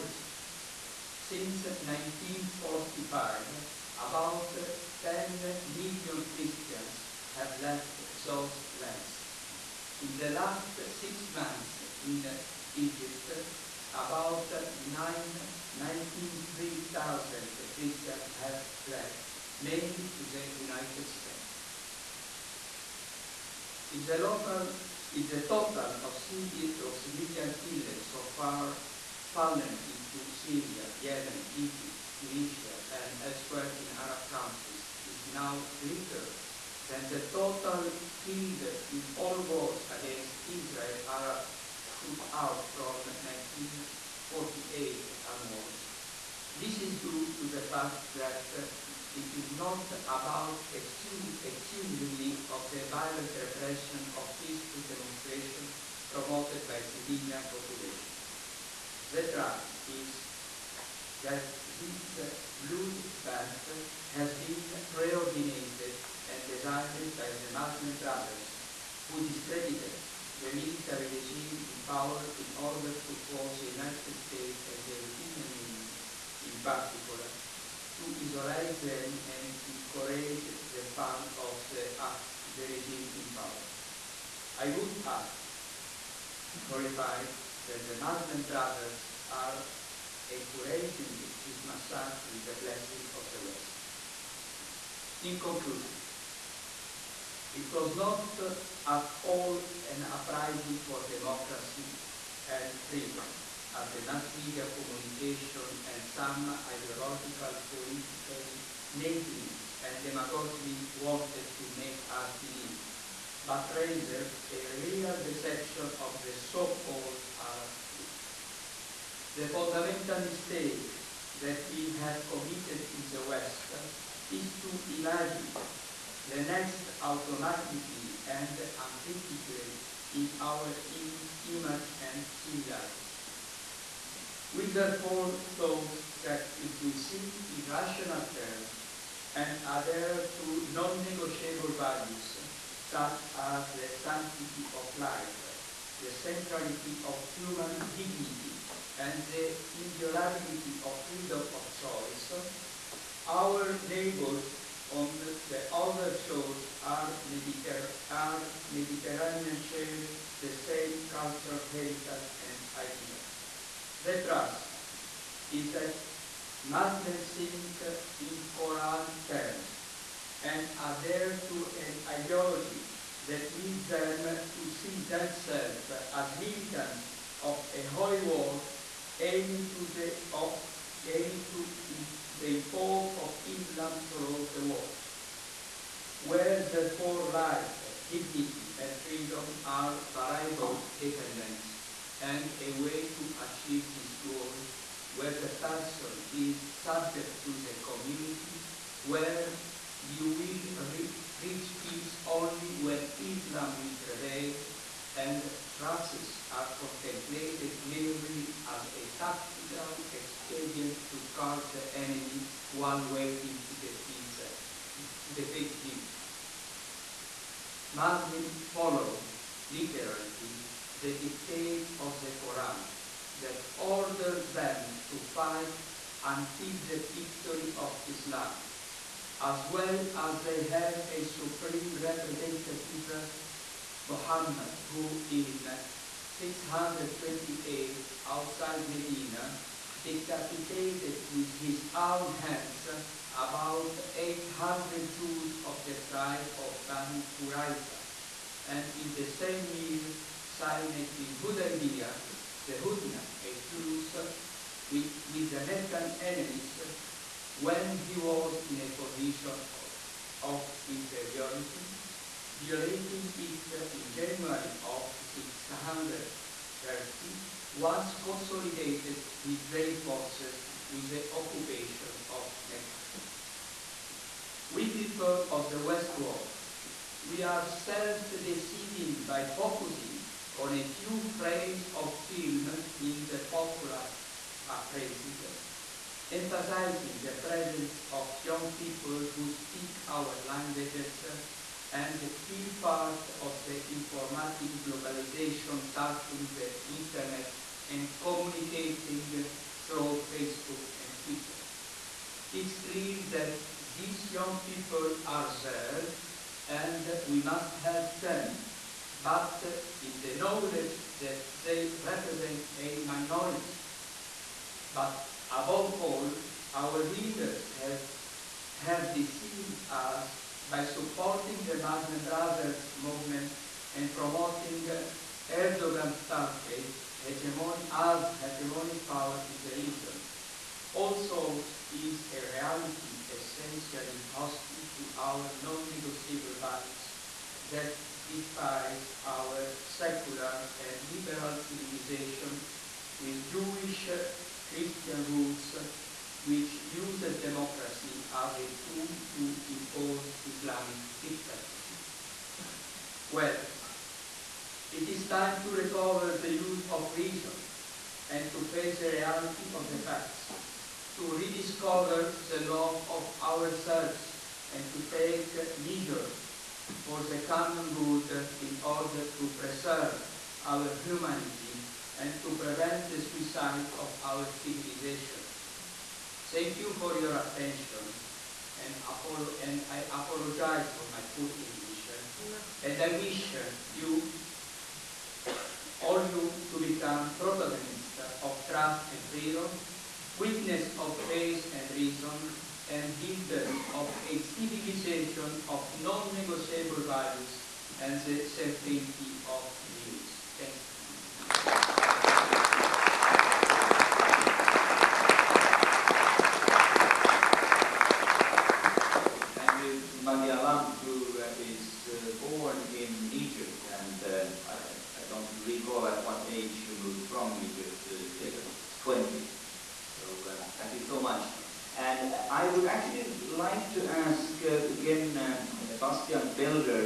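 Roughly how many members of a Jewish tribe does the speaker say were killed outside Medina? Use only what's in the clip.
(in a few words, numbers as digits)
800.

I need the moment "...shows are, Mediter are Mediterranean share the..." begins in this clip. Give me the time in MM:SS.
02:36.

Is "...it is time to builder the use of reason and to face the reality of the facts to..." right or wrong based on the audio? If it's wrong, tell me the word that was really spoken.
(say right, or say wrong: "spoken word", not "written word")
wrong: "recover", not "builder".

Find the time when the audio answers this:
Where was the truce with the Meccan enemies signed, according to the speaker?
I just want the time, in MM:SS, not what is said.
04:11.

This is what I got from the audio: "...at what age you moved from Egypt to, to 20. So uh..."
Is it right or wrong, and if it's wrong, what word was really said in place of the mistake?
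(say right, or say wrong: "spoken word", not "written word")
right.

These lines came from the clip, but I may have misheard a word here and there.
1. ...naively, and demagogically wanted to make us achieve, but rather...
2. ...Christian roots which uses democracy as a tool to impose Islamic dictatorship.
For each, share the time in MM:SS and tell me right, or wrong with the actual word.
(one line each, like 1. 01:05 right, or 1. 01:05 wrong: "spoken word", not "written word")
1. 01:48 wrong: "believe", not "achieve"
2. 05:44 right.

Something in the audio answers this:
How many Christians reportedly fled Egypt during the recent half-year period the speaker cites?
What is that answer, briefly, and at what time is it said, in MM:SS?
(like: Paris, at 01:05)
19,000, at 00:14.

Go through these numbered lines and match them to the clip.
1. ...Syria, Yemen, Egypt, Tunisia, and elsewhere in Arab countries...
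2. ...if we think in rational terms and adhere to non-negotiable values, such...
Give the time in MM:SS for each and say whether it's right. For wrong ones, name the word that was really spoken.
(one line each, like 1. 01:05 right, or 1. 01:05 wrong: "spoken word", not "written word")
1. 00:30 right
2. 02:16 right.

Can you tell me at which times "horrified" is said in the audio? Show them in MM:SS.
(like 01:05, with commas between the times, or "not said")
01:26.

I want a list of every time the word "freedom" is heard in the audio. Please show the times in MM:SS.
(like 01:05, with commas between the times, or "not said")
01:42, 02:31, 03:09, 06:29.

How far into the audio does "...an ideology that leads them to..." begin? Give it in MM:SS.
02:51.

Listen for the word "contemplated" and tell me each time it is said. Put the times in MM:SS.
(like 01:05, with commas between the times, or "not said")
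03:26.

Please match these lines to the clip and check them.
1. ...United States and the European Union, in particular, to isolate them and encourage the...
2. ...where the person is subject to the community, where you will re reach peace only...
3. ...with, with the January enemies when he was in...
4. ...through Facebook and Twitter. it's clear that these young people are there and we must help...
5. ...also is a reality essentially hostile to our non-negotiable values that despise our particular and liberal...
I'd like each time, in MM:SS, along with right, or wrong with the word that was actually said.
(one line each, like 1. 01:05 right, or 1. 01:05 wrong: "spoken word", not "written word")
1. 01:13 right
2. 03:15 right
3. 04:14 wrong: "Meccan", not "January"
4. 04:59 right
5. 05:30 wrong: "secular", not "particular".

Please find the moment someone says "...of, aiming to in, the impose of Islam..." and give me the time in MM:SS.
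03:00.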